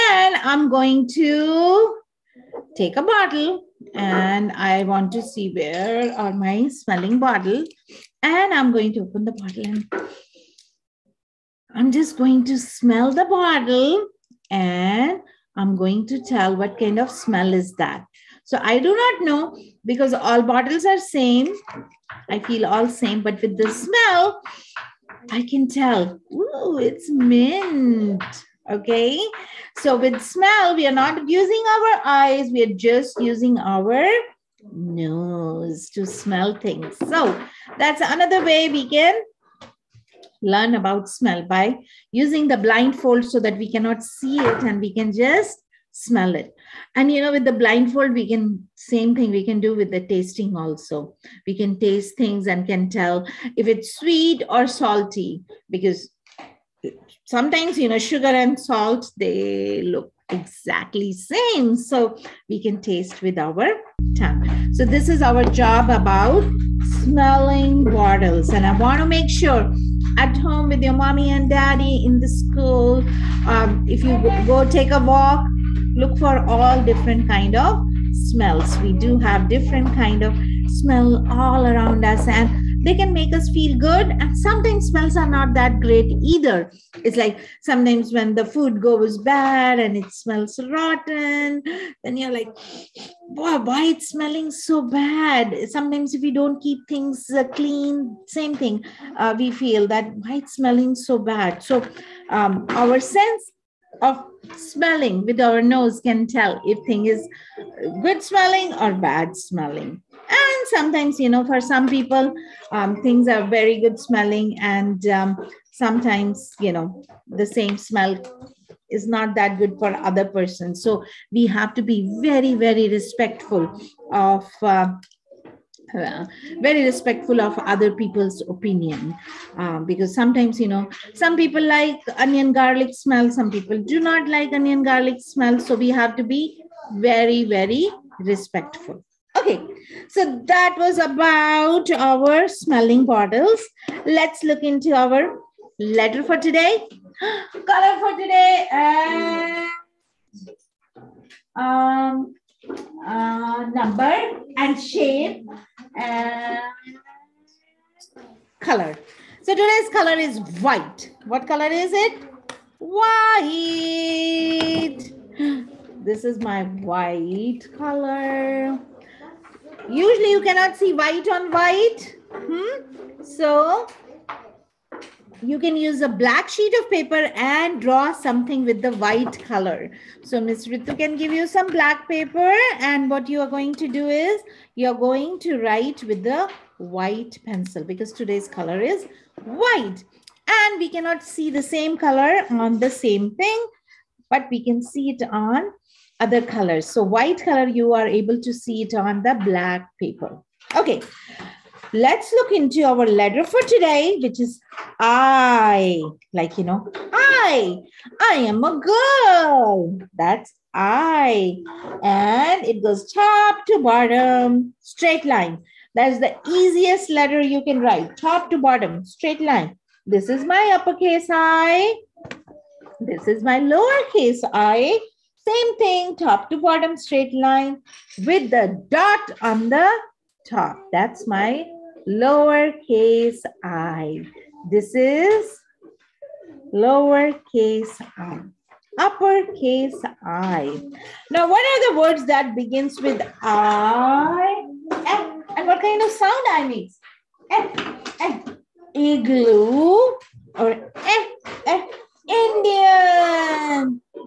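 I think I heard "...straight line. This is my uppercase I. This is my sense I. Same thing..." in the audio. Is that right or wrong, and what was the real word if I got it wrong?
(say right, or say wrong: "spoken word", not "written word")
wrong: "lowercase", not "sense".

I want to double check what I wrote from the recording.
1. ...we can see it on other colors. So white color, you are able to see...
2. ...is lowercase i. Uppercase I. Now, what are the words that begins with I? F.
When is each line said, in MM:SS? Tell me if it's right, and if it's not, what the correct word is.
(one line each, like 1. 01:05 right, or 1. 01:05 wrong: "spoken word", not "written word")
1. 03:14 right
2. 03:54 right.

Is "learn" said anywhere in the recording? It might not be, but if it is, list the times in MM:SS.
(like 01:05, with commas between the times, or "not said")
00:40.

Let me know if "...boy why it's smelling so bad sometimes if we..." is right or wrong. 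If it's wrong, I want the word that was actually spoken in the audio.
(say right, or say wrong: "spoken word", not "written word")
right.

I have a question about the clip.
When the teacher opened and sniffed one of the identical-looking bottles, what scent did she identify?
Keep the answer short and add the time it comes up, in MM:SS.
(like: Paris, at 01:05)
Mint, at 00:26.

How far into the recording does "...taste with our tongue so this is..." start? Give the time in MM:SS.
01:02.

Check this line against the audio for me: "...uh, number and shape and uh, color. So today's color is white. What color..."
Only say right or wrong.
right.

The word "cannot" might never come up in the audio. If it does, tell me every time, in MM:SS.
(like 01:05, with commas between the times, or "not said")
00:43, 02:50, 03:10.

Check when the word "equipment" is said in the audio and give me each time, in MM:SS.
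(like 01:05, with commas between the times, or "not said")
not said.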